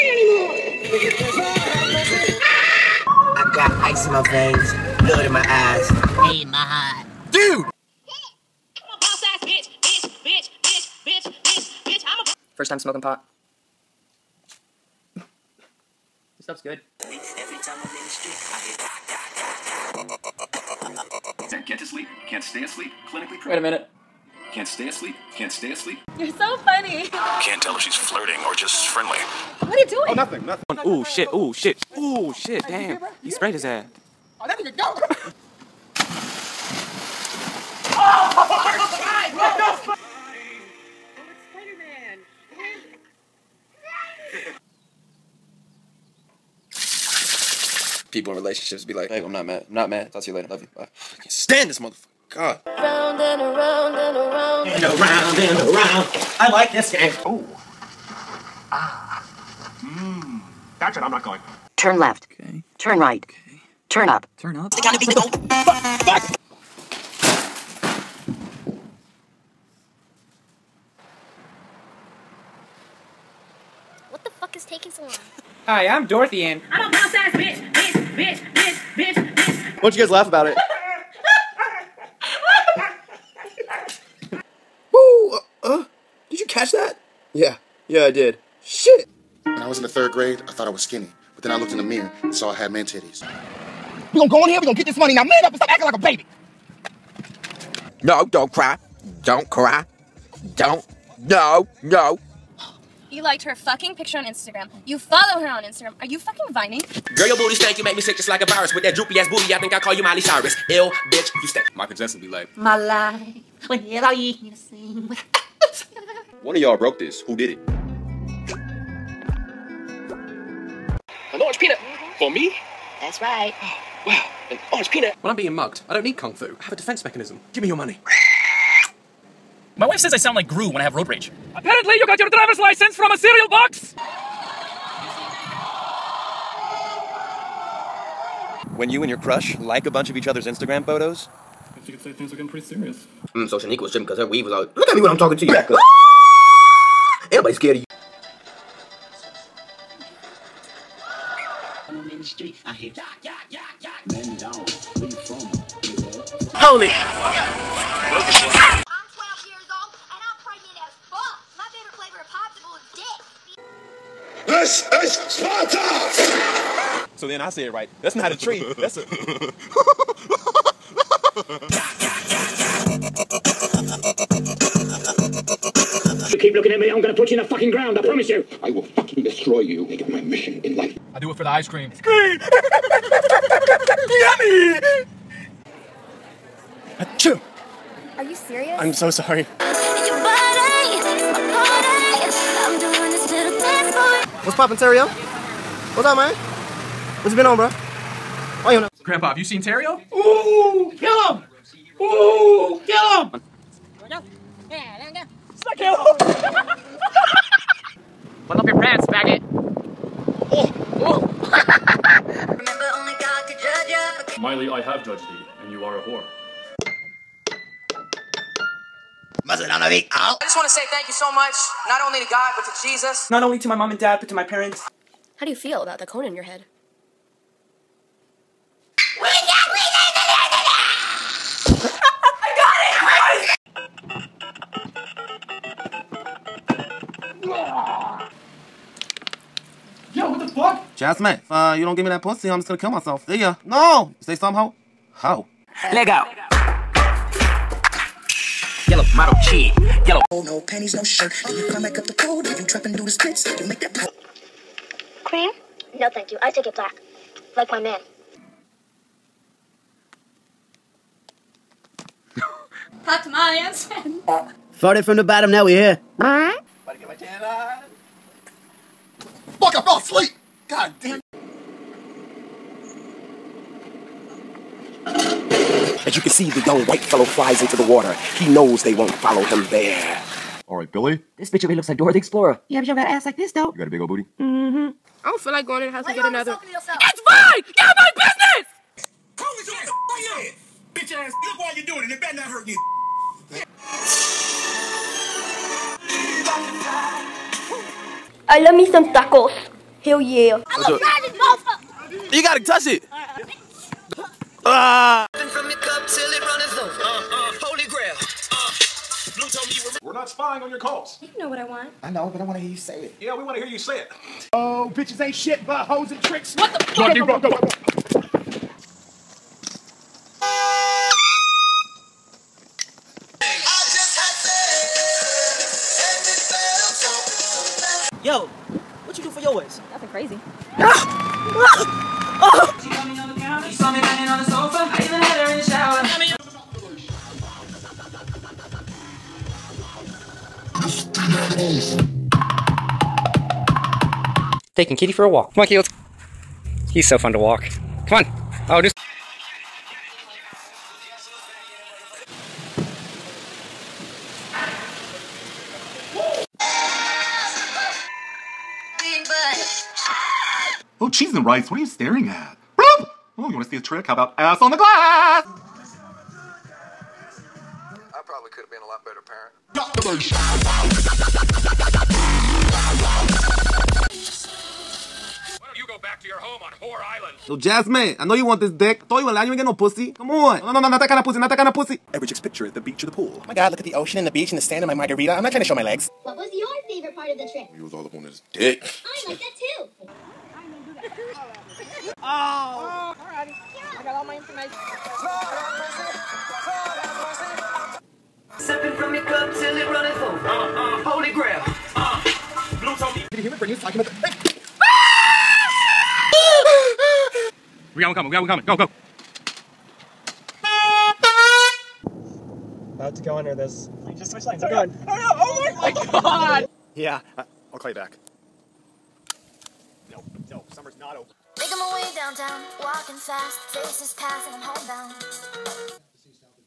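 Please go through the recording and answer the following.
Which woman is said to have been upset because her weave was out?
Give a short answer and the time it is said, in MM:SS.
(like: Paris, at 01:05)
Shanika, at 02:23.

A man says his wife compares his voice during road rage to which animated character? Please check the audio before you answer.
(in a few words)
Gru.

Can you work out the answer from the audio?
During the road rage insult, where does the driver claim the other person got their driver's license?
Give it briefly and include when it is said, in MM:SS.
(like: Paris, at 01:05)
A cereal box, at 02:13.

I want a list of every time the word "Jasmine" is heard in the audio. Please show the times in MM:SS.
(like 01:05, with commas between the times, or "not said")
04:00, 06:17.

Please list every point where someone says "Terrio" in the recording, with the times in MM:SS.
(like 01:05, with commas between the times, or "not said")
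03:14, 03:19.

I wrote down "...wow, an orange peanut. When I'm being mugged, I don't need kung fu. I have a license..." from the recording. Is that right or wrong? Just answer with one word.
wrong.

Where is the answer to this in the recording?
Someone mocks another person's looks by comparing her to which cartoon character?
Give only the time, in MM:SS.
04:41.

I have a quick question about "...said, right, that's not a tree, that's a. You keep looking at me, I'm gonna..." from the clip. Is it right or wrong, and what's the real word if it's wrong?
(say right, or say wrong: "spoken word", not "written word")
right.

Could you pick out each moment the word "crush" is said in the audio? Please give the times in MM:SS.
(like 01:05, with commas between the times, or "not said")
02:19.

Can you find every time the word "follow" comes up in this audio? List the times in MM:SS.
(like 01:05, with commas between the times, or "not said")
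01:44, 04:39.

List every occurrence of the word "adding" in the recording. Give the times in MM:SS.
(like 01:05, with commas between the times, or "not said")
not said.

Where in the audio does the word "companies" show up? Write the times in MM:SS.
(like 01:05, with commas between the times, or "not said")
not said.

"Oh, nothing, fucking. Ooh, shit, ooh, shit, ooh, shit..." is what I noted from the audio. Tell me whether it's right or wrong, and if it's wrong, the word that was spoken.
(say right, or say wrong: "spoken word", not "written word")
wrong: "nothing", not "fucking".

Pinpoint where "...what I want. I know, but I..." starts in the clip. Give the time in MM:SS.
05:11.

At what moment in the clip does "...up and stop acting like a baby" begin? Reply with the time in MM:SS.
01:35.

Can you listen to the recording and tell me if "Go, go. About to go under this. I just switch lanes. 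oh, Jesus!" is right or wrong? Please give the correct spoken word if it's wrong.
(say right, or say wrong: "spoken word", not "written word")
wrong: "God", not "Jesus".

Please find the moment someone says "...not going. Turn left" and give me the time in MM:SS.
01:01.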